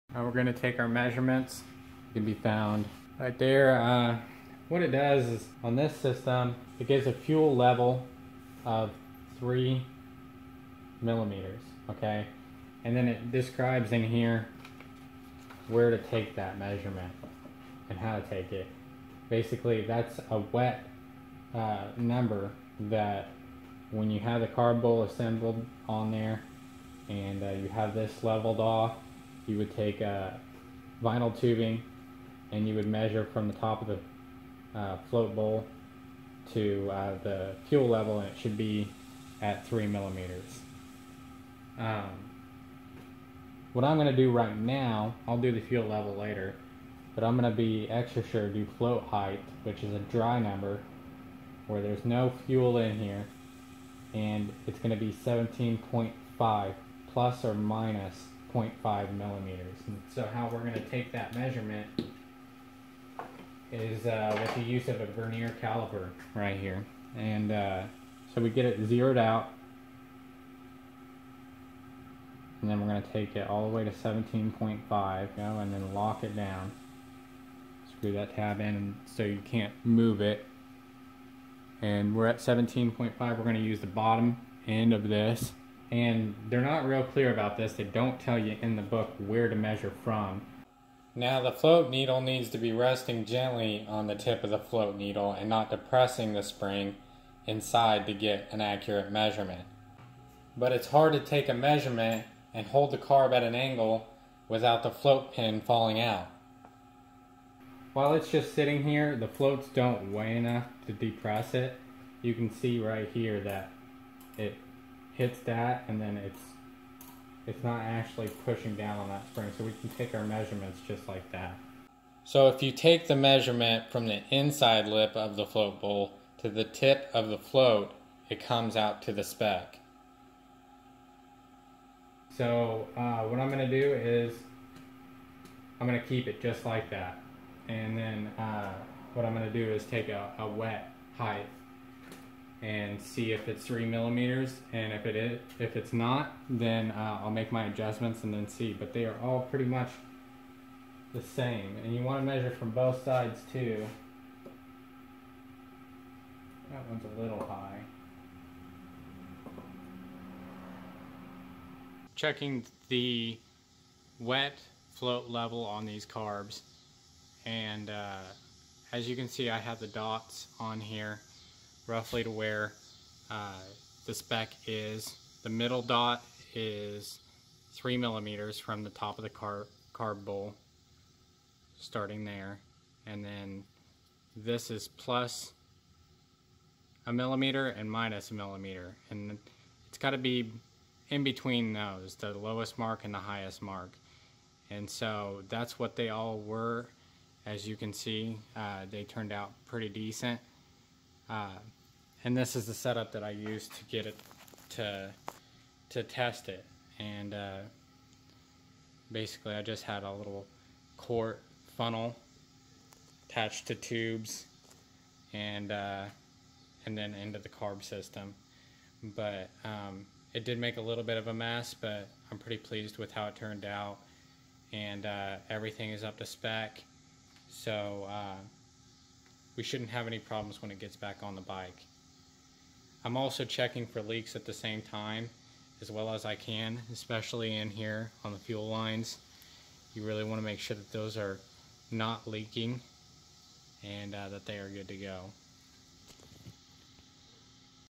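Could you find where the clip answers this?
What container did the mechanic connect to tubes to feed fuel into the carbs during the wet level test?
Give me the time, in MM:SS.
03:30.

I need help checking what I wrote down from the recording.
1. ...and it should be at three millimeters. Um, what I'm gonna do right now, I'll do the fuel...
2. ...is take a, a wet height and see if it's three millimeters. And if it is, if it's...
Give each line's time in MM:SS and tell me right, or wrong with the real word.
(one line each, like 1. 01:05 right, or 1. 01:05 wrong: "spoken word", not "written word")
1. 00:38 right
2. 02:19 right.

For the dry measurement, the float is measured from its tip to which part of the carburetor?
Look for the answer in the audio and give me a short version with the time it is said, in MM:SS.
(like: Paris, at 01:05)
inside lip of the float bowl, at 02:04.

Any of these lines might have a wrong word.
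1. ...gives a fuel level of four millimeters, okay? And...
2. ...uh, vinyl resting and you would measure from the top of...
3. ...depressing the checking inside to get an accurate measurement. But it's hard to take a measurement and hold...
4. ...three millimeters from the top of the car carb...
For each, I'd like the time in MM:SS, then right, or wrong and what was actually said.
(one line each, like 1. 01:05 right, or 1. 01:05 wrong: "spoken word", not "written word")
1. 00:06 wrong: "three", not "four"
2. 00:30 wrong: "tubing", not "resting"
3. 01:35 wrong: "spring", not "checking"
4. 02:57 right.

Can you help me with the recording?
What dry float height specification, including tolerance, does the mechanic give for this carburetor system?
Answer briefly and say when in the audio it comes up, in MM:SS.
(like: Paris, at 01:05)
17.5 ± 0.5 mm, at 00:55.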